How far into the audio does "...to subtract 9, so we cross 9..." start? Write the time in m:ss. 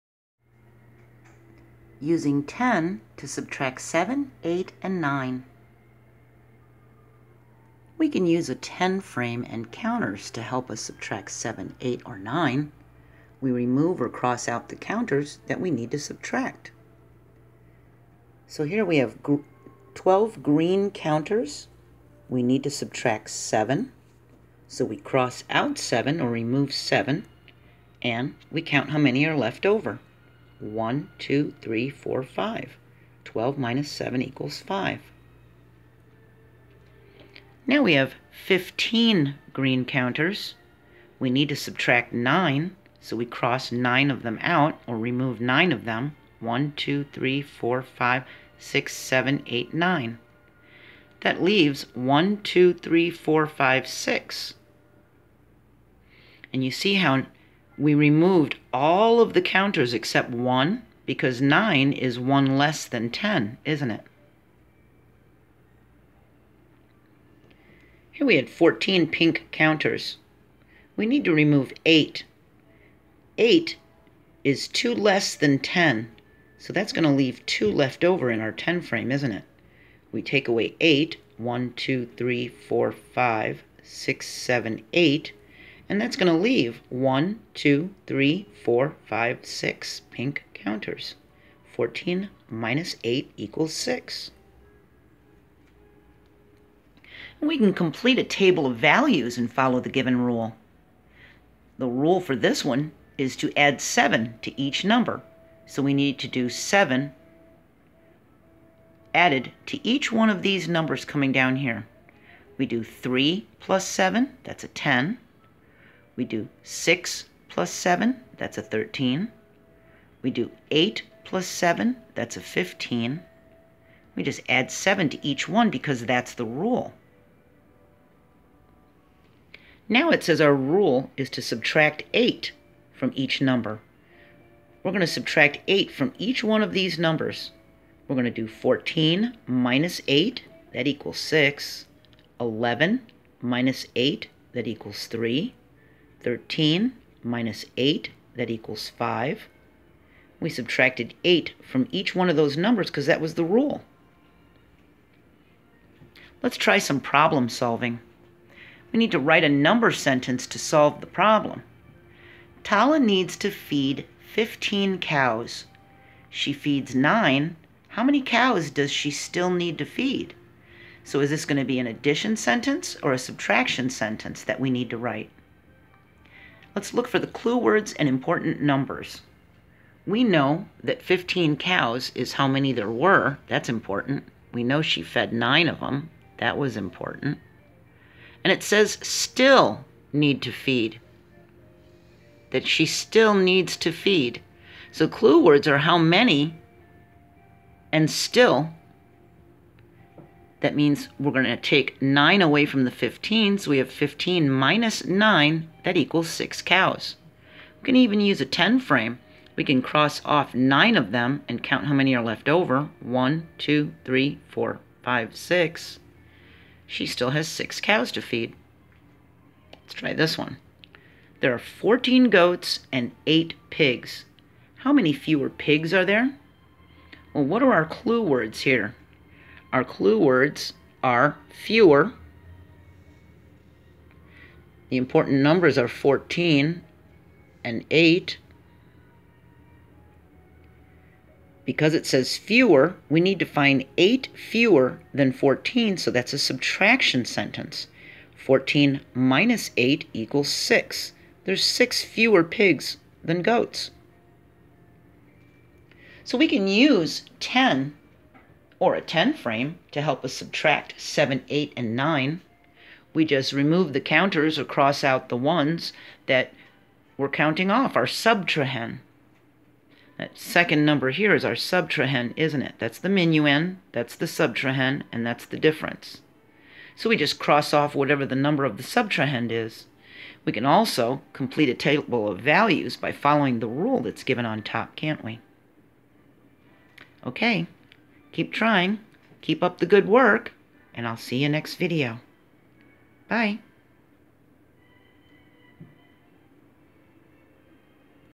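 0:41.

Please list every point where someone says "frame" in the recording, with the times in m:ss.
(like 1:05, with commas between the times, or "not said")
0:09, 1:18, 3:28, 4:19.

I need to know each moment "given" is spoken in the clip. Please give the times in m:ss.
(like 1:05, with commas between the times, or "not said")
1:39, 4:44.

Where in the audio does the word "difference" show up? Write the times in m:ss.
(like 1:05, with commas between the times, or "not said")
4:35.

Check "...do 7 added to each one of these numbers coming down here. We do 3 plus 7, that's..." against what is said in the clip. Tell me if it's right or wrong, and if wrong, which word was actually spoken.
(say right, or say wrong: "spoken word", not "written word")
right.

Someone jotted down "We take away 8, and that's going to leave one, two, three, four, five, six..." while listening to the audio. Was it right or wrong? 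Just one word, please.
right.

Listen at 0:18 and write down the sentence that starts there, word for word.
So here we have 12 green counters.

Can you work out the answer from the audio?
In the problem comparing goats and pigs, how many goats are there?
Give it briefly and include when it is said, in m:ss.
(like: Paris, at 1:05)
14, at 3:41.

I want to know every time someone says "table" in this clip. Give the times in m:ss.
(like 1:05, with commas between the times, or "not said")
1:38, 4:41.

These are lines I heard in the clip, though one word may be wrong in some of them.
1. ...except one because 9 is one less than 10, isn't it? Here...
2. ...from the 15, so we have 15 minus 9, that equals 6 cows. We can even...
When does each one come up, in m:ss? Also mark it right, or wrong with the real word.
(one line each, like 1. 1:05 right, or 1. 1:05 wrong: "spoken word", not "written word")
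1. 0:59 right
2. 3:22 right.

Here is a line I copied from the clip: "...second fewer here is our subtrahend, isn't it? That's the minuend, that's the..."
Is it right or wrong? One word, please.
wrong.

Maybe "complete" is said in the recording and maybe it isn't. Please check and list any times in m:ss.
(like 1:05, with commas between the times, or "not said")
1:37, 4:41.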